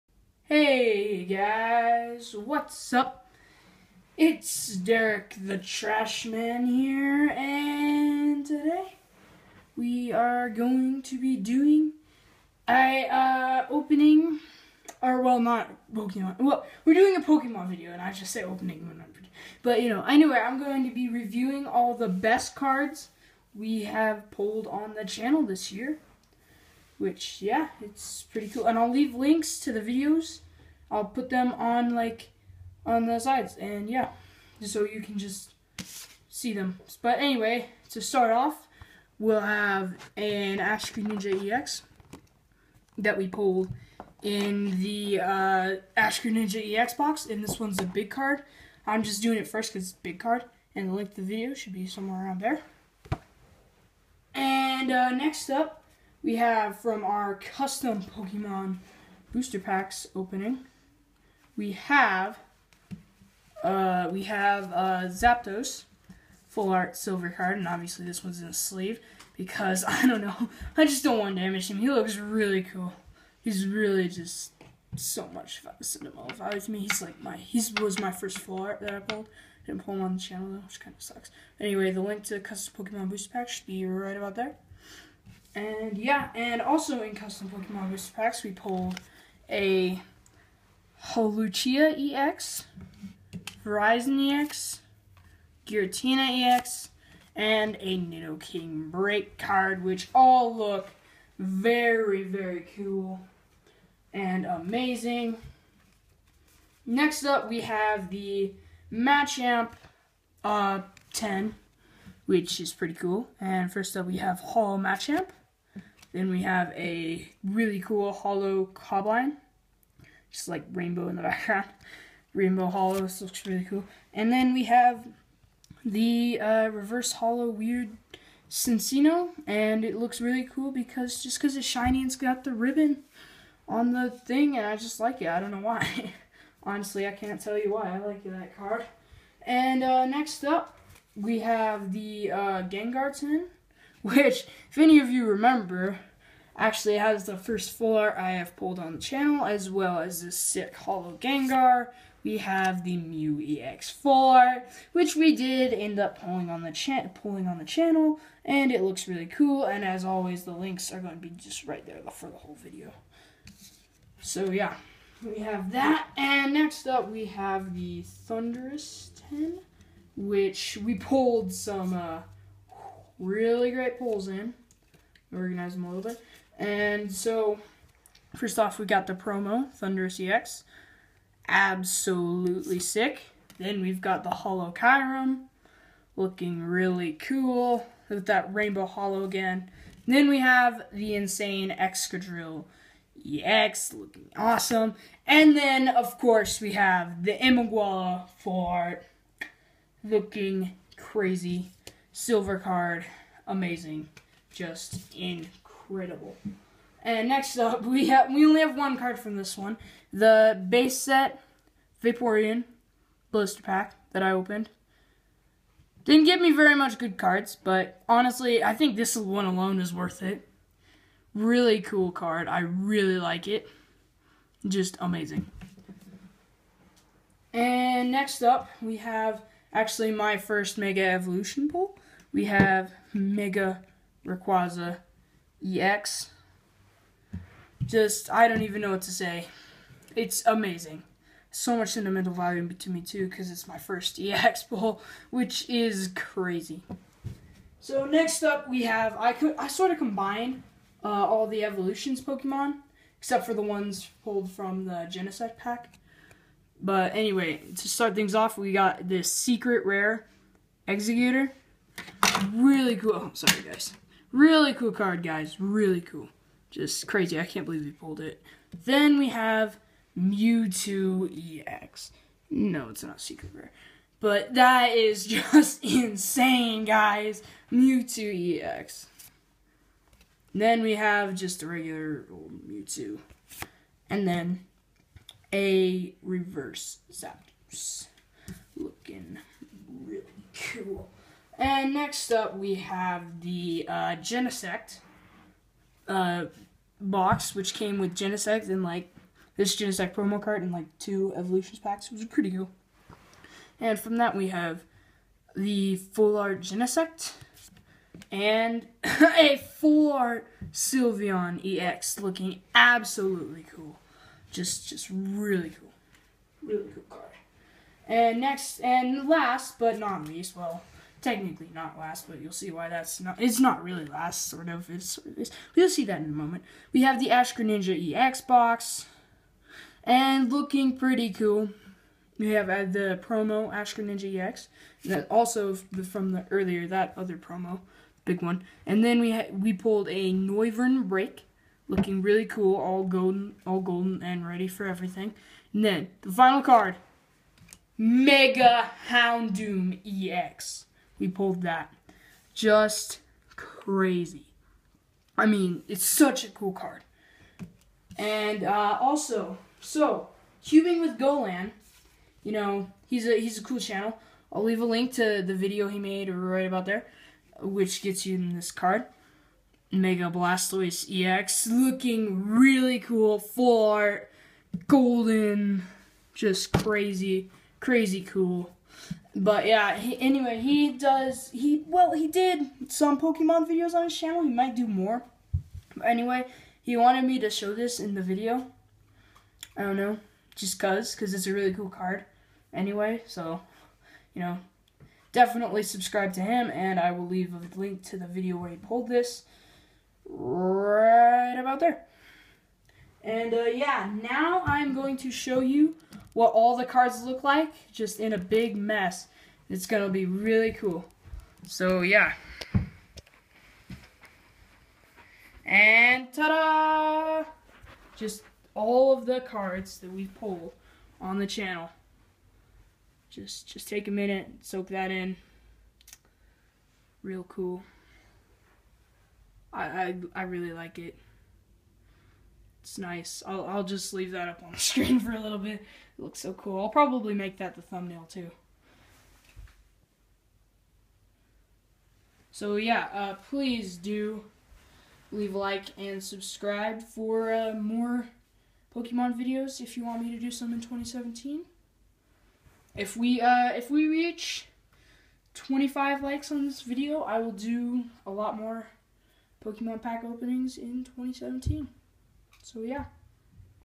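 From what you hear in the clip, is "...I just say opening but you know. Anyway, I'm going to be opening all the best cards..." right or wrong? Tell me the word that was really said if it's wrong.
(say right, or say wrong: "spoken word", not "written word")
wrong: "reviewing", not "opening".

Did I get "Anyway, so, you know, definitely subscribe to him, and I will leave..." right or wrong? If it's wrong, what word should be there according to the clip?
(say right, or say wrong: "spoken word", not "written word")
right.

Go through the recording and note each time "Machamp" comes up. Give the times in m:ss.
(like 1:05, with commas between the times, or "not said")
1:48, 1:54.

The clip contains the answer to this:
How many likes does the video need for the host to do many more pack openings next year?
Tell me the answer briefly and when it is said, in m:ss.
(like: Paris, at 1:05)
25, at 7:35.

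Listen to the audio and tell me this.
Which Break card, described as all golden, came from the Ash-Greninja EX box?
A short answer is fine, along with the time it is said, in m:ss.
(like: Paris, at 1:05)
Noivern Break, at 5:40.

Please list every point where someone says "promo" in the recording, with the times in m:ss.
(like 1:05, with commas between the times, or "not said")
2:59, 5:00, 5:33, 5:37.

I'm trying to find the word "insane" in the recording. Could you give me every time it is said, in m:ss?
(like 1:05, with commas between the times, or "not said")
3:11, 4:35.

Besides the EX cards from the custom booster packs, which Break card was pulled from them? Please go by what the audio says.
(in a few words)
Nidoking Break.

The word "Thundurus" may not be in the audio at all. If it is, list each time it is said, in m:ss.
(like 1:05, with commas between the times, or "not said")
2:48, 2:59.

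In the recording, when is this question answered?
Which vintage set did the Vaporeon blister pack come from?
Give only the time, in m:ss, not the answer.
3:30.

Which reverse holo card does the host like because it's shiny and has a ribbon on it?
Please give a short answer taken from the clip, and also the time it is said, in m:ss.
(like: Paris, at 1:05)
Cinccino, at 2:08.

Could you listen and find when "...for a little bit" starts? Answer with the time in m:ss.
7:15.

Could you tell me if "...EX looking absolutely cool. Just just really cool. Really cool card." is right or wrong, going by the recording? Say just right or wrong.
right.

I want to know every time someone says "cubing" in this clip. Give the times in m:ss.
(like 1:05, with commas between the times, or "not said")
6:00.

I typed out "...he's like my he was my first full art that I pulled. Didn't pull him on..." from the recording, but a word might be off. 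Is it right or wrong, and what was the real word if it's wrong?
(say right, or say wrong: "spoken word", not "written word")
right.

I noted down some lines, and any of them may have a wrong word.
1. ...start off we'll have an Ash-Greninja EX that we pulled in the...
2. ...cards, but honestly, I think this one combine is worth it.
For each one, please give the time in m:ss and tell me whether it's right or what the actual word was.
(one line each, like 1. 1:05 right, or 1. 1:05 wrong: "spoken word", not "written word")
1. 0:38 right
2. 3:37 wrong: "alone", not "combine".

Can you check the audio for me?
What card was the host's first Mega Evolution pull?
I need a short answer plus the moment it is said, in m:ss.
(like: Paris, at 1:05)
Mega Rayquaza EX, at 3:53.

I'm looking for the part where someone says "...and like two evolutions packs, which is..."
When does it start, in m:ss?
5:00.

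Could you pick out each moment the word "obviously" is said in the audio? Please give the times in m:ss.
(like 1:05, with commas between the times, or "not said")
1:07.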